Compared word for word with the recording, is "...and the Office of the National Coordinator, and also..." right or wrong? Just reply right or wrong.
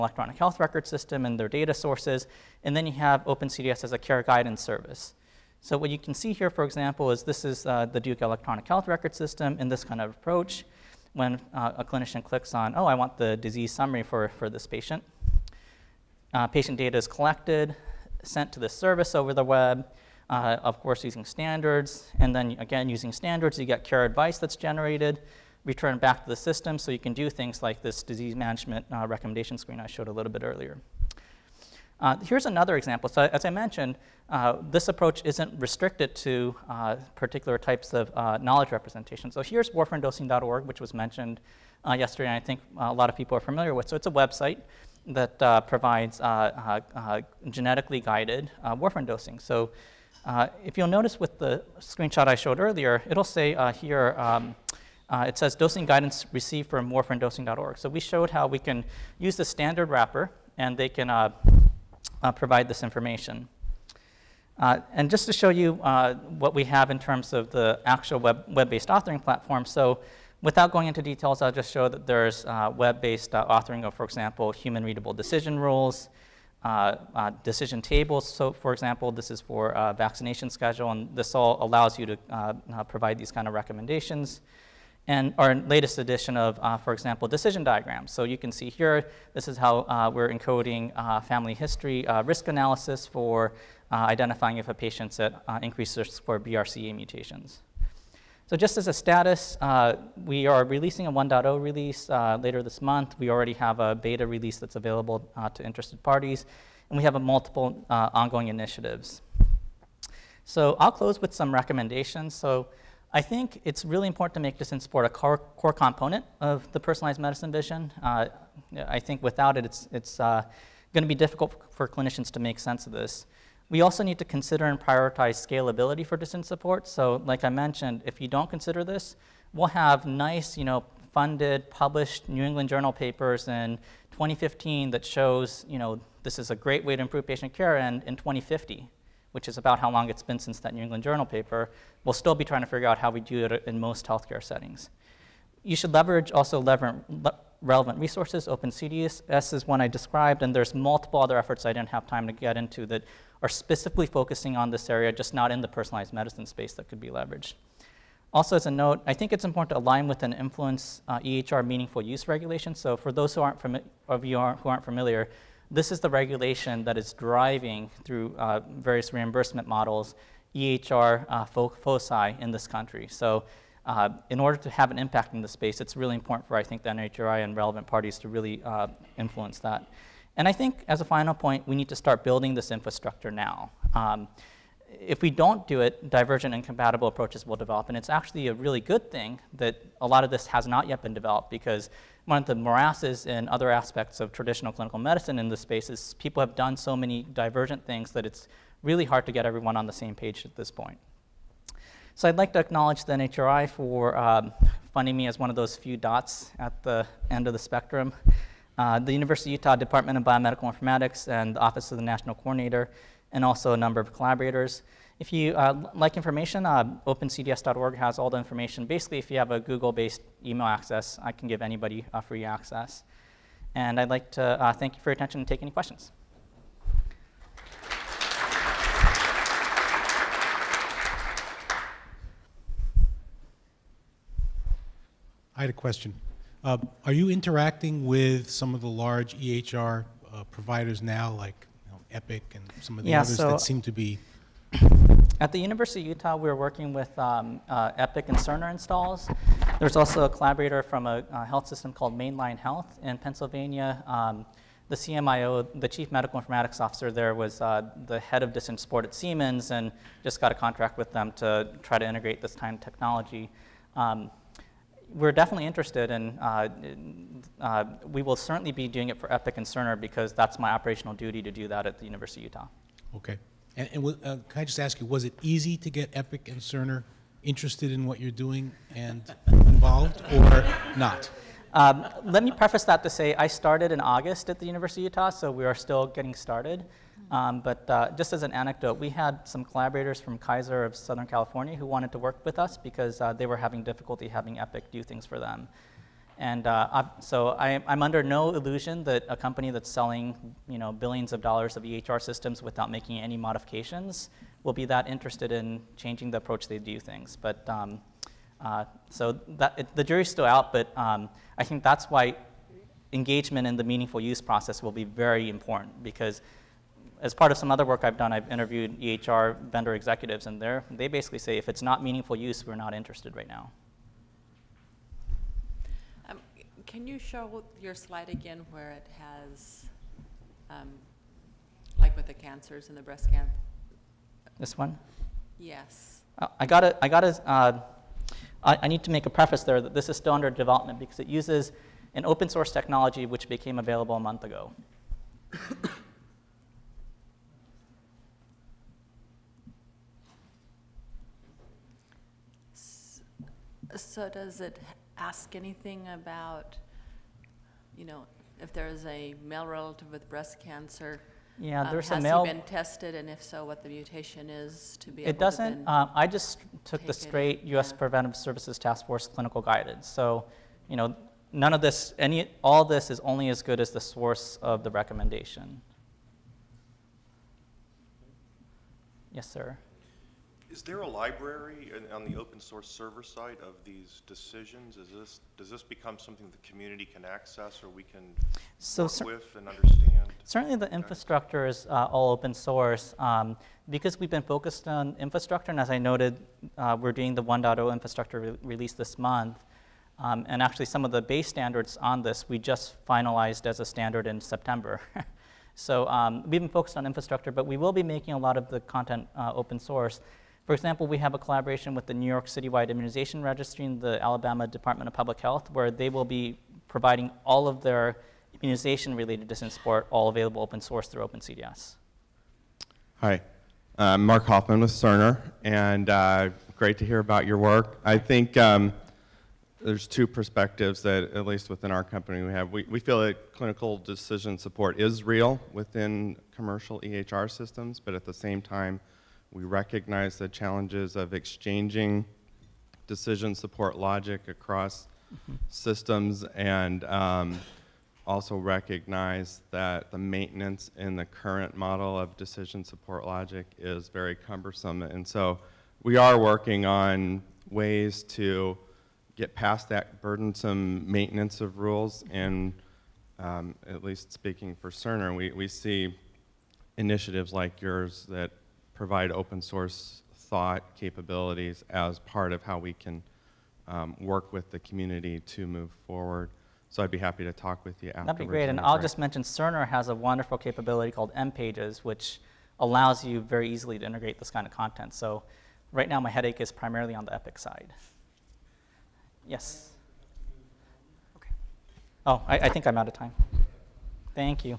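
right.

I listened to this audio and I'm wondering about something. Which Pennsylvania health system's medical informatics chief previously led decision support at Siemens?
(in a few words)
Main Line Health.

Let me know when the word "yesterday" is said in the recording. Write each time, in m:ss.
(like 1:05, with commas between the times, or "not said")
0:41.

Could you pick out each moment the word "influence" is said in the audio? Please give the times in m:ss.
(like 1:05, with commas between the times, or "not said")
2:40, 2:59.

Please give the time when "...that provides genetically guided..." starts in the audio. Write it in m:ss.
0:45.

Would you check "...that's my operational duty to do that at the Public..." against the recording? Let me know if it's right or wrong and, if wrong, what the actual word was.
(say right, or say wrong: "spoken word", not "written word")
wrong: "University", not "Public".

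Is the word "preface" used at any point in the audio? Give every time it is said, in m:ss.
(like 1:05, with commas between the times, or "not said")
4:42, 5:39.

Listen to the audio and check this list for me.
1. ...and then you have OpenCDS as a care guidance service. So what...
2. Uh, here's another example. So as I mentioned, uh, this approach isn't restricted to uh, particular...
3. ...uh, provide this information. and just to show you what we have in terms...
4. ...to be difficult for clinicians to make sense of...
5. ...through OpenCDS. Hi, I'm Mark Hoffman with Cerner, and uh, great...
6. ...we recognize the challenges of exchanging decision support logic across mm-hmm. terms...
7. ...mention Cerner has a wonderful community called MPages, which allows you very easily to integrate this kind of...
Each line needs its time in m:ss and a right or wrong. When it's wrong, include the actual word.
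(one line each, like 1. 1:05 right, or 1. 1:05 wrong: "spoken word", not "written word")
1. 0:02 right
2. 0:32 right
3. 1:02 right
4. 2:01 right
5. 7:01 right
6. 7:19 wrong: "systems", not "terms"
7. 7:59 wrong: "capability", not "community".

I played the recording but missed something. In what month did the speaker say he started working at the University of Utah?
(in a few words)
August.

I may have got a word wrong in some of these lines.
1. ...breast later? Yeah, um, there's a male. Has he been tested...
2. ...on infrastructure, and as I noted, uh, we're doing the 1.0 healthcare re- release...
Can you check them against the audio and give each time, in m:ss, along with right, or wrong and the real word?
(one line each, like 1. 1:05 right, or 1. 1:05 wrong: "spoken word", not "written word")
1. 6:00 wrong: "cancer", not "later"
2. 6:34 wrong: "infrastructure", not "healthcare".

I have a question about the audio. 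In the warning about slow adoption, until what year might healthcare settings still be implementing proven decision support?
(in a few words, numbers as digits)
2050.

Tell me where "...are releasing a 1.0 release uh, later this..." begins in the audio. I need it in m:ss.
1:40.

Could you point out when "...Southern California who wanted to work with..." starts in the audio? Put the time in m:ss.
4:50.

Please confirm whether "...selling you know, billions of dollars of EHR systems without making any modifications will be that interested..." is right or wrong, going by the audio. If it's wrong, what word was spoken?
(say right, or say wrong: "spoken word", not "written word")
right.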